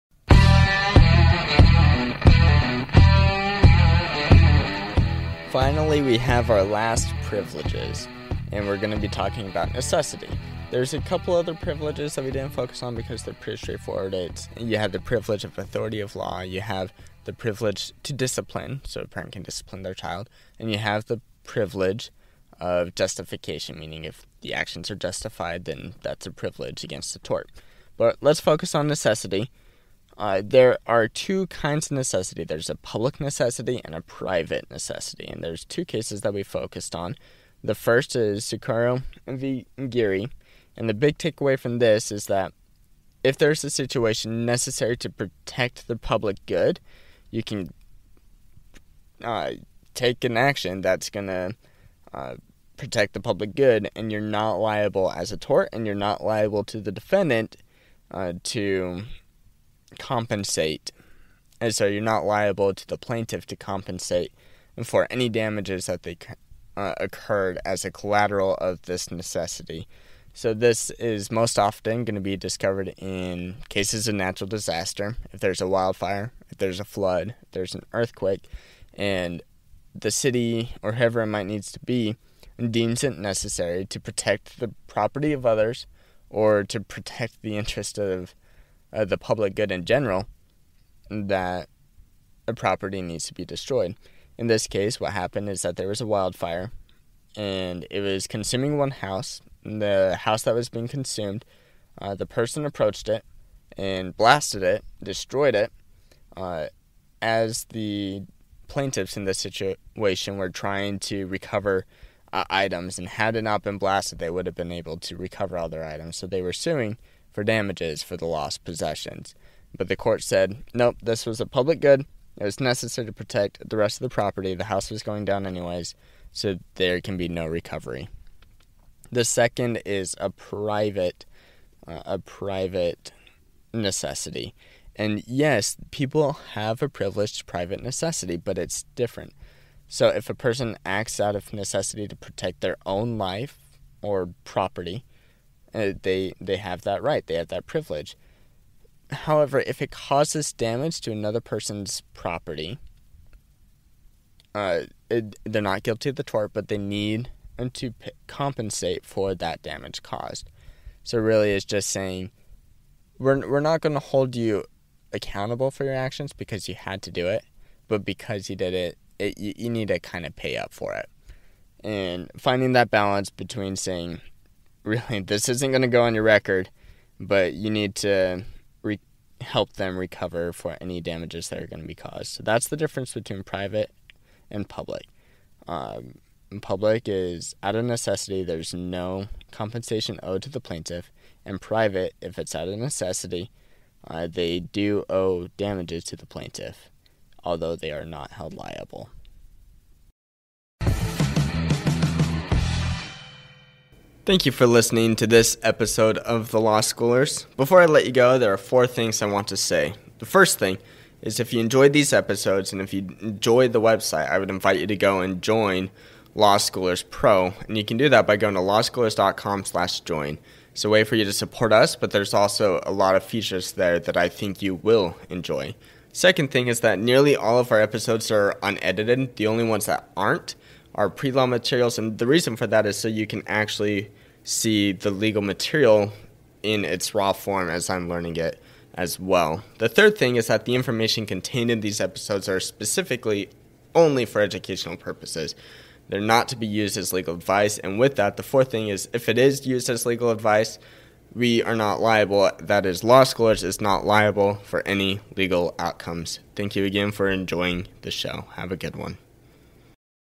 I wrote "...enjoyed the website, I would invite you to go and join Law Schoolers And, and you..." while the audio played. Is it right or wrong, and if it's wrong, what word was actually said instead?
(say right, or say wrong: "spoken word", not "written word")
wrong: "Pro", not "And".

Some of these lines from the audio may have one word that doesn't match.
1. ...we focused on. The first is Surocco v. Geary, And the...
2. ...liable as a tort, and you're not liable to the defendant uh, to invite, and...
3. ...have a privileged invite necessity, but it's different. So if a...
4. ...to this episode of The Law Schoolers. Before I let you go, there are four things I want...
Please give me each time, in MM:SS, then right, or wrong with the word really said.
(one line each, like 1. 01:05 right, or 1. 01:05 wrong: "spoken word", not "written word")
1. 00:36 right
2. 00:54 wrong: "compensate", not "invite"
3. 02:16 wrong: "private", not "invite"
4. 03:25 right.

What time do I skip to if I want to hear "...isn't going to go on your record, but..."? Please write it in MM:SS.
02:55.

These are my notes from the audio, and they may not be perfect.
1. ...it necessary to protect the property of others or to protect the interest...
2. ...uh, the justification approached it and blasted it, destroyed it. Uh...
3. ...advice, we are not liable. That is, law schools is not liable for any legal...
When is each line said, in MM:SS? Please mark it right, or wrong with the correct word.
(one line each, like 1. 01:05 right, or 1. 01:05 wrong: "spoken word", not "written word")
1. 01:23 right
2. 01:42 wrong: "person", not "justification"
3. 04:10 right.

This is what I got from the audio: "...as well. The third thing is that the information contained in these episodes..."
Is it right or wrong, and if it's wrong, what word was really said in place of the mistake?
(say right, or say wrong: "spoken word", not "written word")
right.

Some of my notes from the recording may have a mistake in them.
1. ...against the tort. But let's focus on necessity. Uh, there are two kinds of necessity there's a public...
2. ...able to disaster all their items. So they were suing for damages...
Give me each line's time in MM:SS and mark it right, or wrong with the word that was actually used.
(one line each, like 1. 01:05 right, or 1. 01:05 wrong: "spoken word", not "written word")
1. 00:26 right
2. 01:54 wrong: "recover", not "disaster".